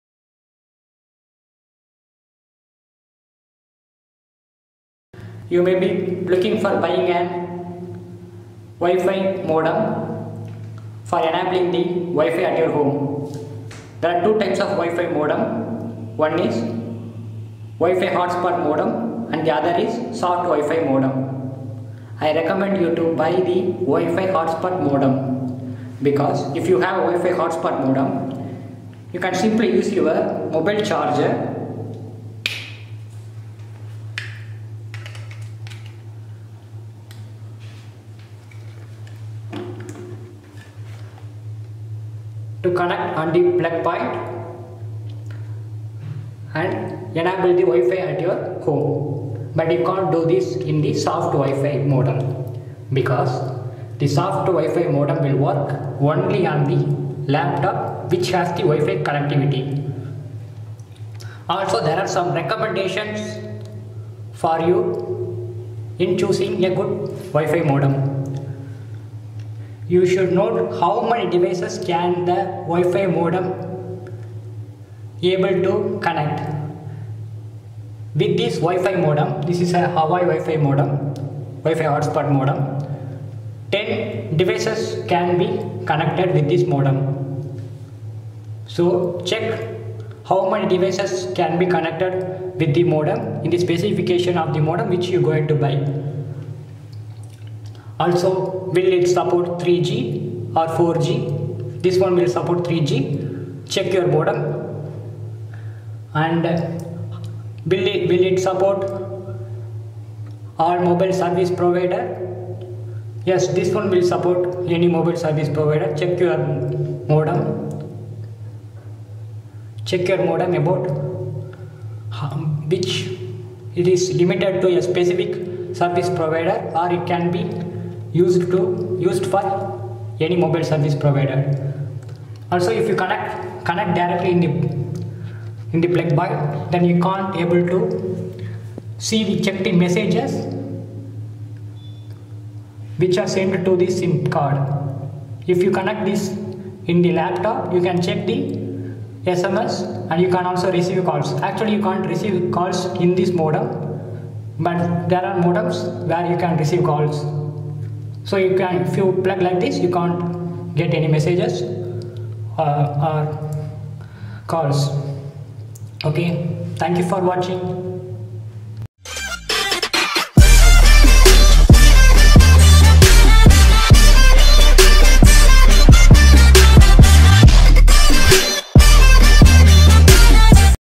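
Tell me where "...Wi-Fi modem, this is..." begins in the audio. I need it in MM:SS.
01:18.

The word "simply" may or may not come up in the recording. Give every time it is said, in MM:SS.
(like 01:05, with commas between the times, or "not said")
00:29.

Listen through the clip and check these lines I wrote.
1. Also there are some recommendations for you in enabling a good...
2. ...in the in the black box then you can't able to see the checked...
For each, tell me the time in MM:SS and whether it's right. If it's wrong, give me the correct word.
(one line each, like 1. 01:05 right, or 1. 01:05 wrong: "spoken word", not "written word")
1. 01:01 wrong: "choosing", not "enabling"
2. 02:14 right.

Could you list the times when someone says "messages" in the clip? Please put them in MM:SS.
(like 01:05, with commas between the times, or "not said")
02:19, 02:41.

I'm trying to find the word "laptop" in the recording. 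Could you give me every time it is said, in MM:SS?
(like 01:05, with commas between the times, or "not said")
00:57, 02:27.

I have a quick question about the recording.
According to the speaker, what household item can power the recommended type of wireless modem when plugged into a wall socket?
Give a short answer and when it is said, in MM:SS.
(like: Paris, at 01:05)
Mobile charger, at 00:30.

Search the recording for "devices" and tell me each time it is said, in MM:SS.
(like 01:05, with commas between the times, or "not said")
01:11, 01:24, 01:30.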